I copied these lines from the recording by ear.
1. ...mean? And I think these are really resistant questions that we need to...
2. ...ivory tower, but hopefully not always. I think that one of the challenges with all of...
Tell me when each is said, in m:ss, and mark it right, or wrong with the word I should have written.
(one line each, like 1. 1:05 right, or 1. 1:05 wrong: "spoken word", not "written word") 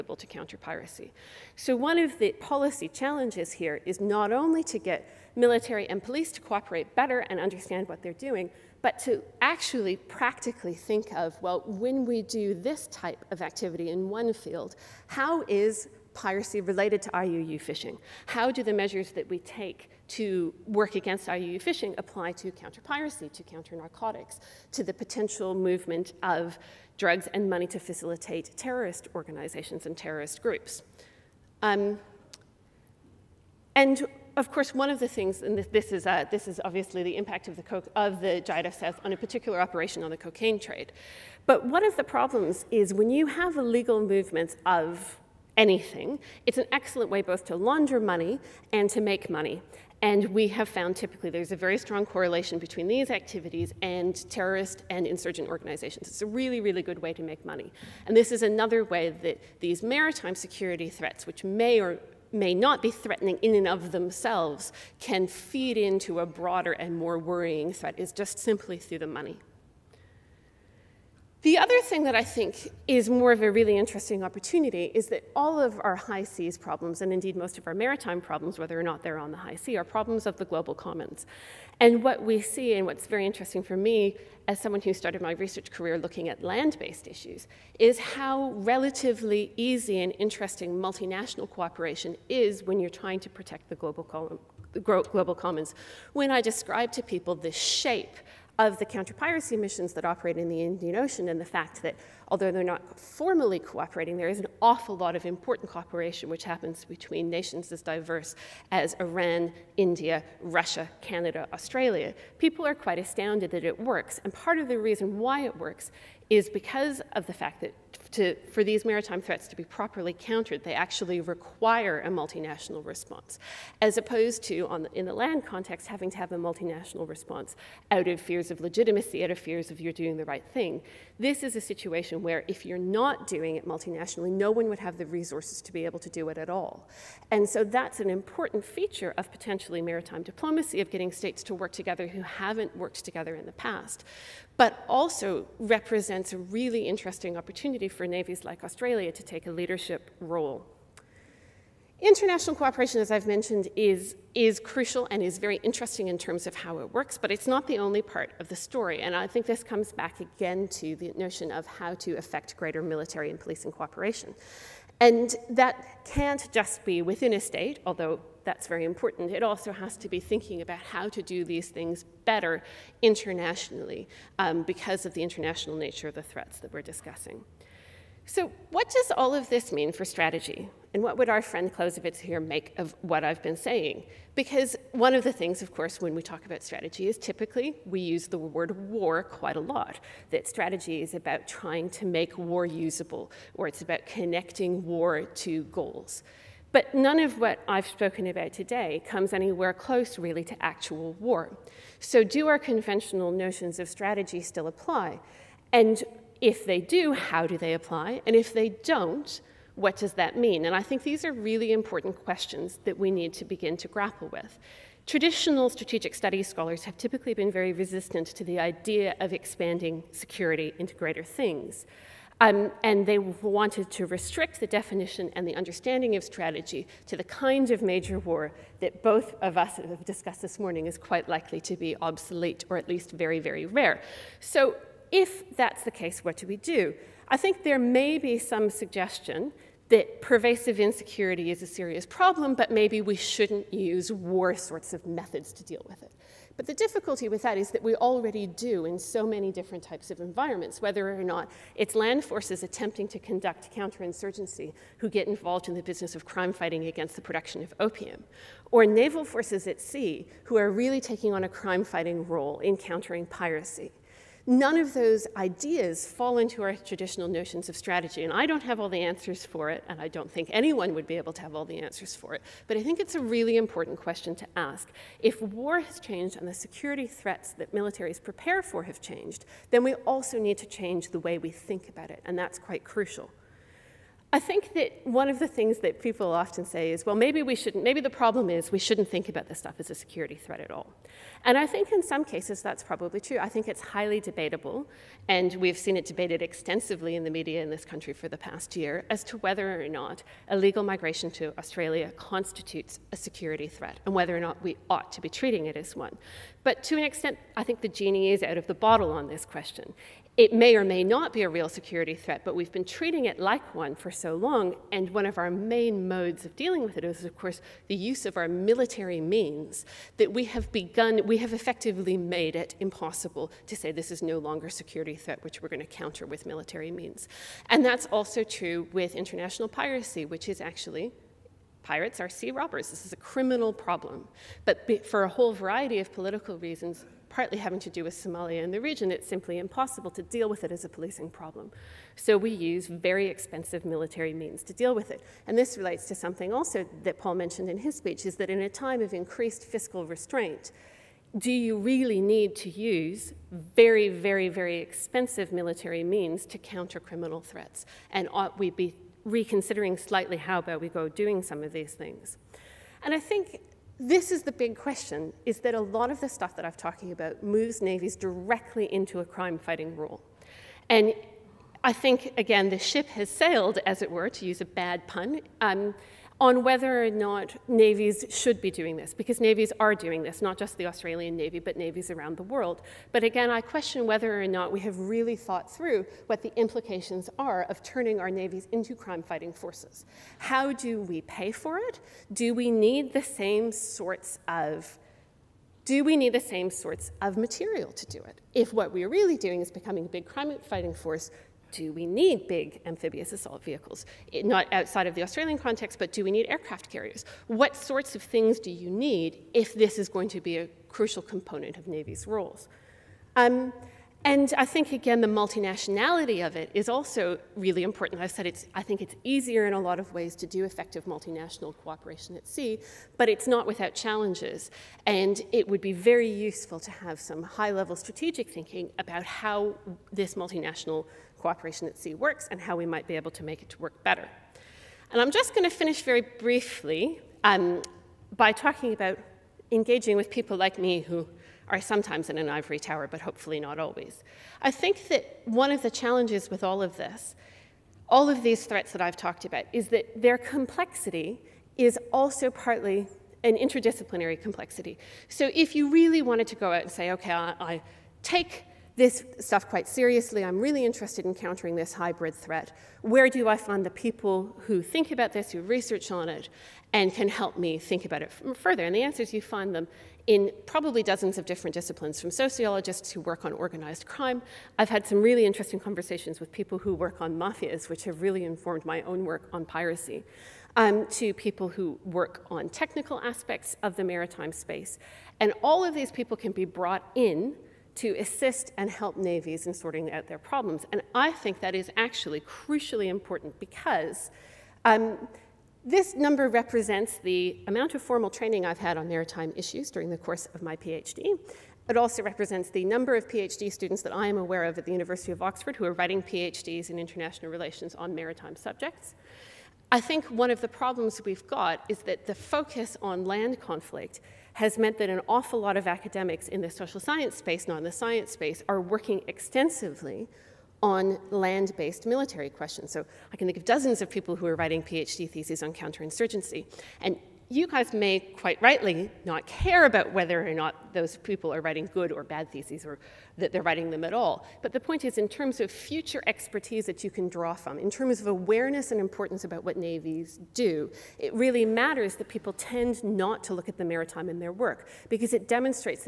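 1. 3:30 wrong: "important", not "resistant"
2. 7:22 right.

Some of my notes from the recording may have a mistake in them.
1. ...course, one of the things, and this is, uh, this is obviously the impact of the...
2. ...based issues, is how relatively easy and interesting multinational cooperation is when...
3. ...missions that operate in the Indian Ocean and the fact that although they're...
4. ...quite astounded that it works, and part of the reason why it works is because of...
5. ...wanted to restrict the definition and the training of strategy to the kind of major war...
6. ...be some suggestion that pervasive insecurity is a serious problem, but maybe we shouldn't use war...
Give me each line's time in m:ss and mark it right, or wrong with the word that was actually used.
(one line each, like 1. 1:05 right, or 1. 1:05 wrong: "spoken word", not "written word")
1. 0:34 right
2. 1:26 right
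3. 1:39 right
4. 1:52 right
5. 3:43 wrong: "understanding", not "training"
6. 3:58 right.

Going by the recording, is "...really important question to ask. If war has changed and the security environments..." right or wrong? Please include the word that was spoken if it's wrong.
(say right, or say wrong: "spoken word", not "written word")
wrong: "threats", not "environments".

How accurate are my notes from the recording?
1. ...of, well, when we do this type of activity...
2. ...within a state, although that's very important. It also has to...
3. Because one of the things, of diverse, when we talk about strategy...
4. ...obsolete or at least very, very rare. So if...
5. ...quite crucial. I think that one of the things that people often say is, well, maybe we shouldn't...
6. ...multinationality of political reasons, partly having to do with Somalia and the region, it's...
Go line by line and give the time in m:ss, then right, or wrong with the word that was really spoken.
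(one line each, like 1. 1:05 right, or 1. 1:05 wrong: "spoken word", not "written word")
1. 0:11 right
2. 2:47 right
3. 3:04 wrong: "course", not "diverse"
4. 3:52 right
5. 4:42 right
6. 5:35 wrong: "variety", not "multinationality".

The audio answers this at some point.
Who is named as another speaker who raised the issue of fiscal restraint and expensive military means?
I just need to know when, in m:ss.
5:47.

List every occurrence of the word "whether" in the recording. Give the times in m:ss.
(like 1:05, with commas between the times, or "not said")
1:18, 4:10, 4:59, 5:04, 6:16, 6:24, 8:50.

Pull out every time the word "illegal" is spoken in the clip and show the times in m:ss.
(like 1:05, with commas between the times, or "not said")
0:43, 5:00.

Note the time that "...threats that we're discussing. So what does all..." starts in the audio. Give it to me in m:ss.
2:56.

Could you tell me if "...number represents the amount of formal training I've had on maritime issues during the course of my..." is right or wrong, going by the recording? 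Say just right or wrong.
right.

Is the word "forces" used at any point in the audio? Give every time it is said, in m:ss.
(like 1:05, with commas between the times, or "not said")
4:12, 4:19, 6:29, 6:40.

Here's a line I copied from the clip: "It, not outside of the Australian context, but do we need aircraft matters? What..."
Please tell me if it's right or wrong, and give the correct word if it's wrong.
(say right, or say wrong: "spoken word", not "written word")
wrong: "carriers", not "matters".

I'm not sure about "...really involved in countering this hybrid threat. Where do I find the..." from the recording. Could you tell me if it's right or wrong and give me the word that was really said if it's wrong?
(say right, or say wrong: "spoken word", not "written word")
wrong: "interested", not "involved".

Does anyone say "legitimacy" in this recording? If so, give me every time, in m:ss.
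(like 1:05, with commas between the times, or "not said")
2:08.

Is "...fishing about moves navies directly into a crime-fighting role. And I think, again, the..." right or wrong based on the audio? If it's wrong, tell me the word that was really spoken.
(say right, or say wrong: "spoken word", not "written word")
wrong: "talking", not "fishing".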